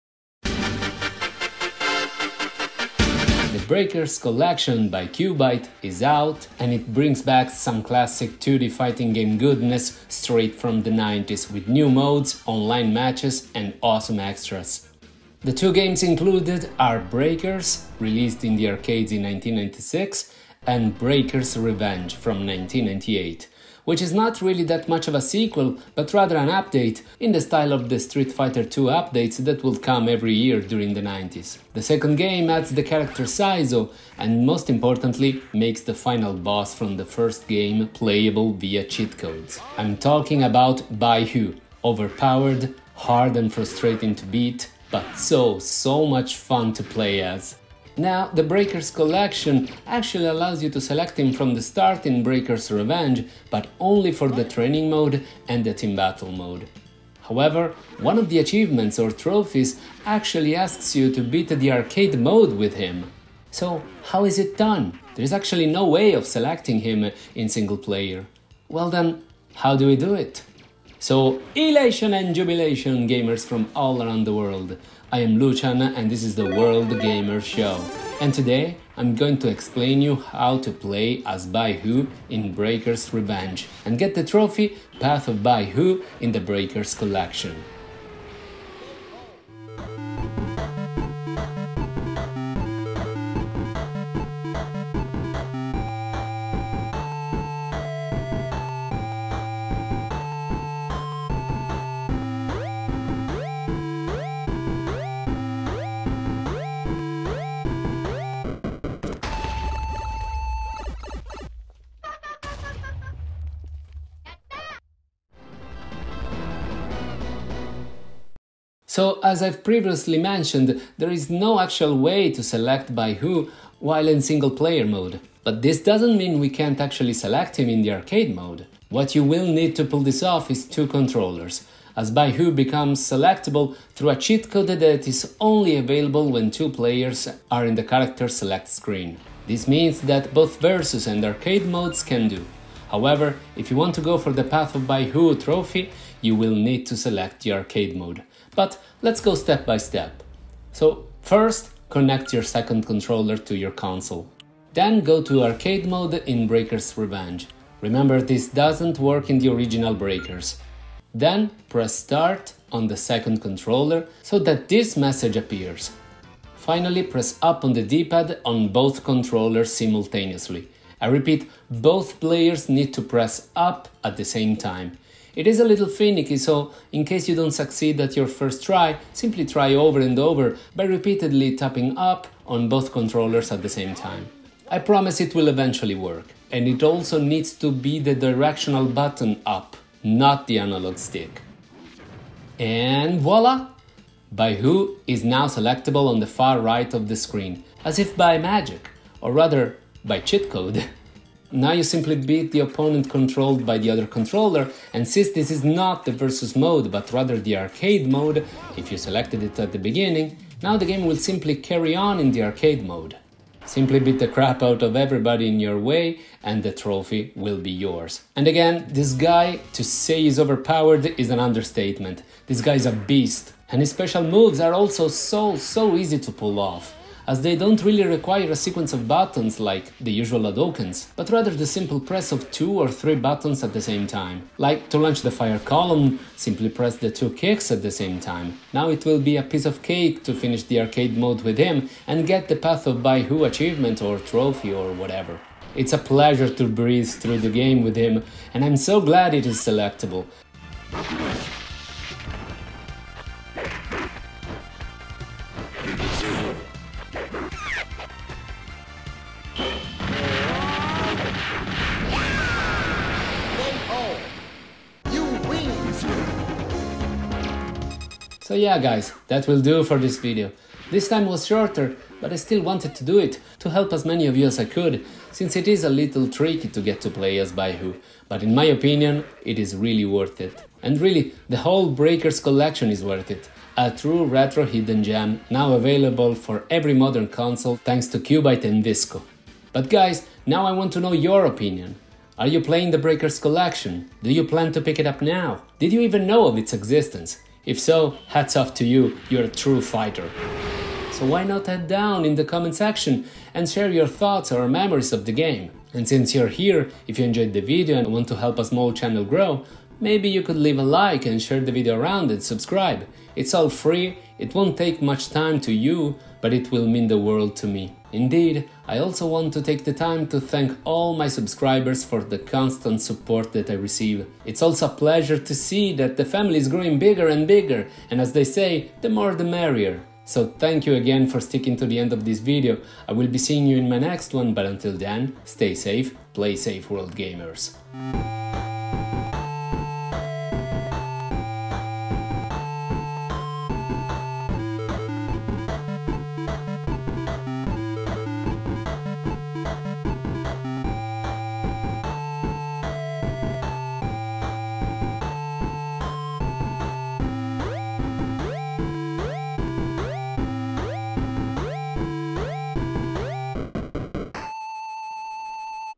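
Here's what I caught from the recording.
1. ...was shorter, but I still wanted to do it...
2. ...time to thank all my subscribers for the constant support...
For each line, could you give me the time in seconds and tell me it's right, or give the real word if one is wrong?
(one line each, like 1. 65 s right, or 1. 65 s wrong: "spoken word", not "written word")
1. 271 s right
2. 319 s right.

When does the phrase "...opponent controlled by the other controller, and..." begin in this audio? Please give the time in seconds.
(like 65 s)
202 s.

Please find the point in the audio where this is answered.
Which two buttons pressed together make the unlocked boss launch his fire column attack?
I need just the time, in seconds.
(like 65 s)
237 s.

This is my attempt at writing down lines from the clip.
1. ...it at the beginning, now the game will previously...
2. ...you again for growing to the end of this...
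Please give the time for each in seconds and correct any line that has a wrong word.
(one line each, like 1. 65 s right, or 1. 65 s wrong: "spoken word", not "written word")
1. 209 s wrong: "simply", not "previously"
2. 330 s wrong: "sticking", not "growing".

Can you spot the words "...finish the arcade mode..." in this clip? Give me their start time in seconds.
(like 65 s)
240 s.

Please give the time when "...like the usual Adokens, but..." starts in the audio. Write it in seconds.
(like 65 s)
229 s.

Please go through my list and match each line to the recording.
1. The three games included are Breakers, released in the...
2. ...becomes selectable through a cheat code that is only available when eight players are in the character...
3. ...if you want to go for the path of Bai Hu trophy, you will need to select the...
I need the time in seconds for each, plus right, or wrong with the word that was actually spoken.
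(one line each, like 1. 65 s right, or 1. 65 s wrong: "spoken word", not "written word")
1. 15 s wrong: "two", not "three"
2. 132 s wrong: "two", not "eight"
3. 143 s right.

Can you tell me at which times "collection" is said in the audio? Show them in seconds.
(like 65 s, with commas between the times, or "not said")
4 s, 48 s, 86 s, 282 s, 293 s.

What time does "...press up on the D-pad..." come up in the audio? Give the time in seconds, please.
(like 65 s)
167 s.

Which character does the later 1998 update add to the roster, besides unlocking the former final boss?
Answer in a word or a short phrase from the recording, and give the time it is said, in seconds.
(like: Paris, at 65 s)
Saizo, at 33 s.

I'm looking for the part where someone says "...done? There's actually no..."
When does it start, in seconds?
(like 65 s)
64 s.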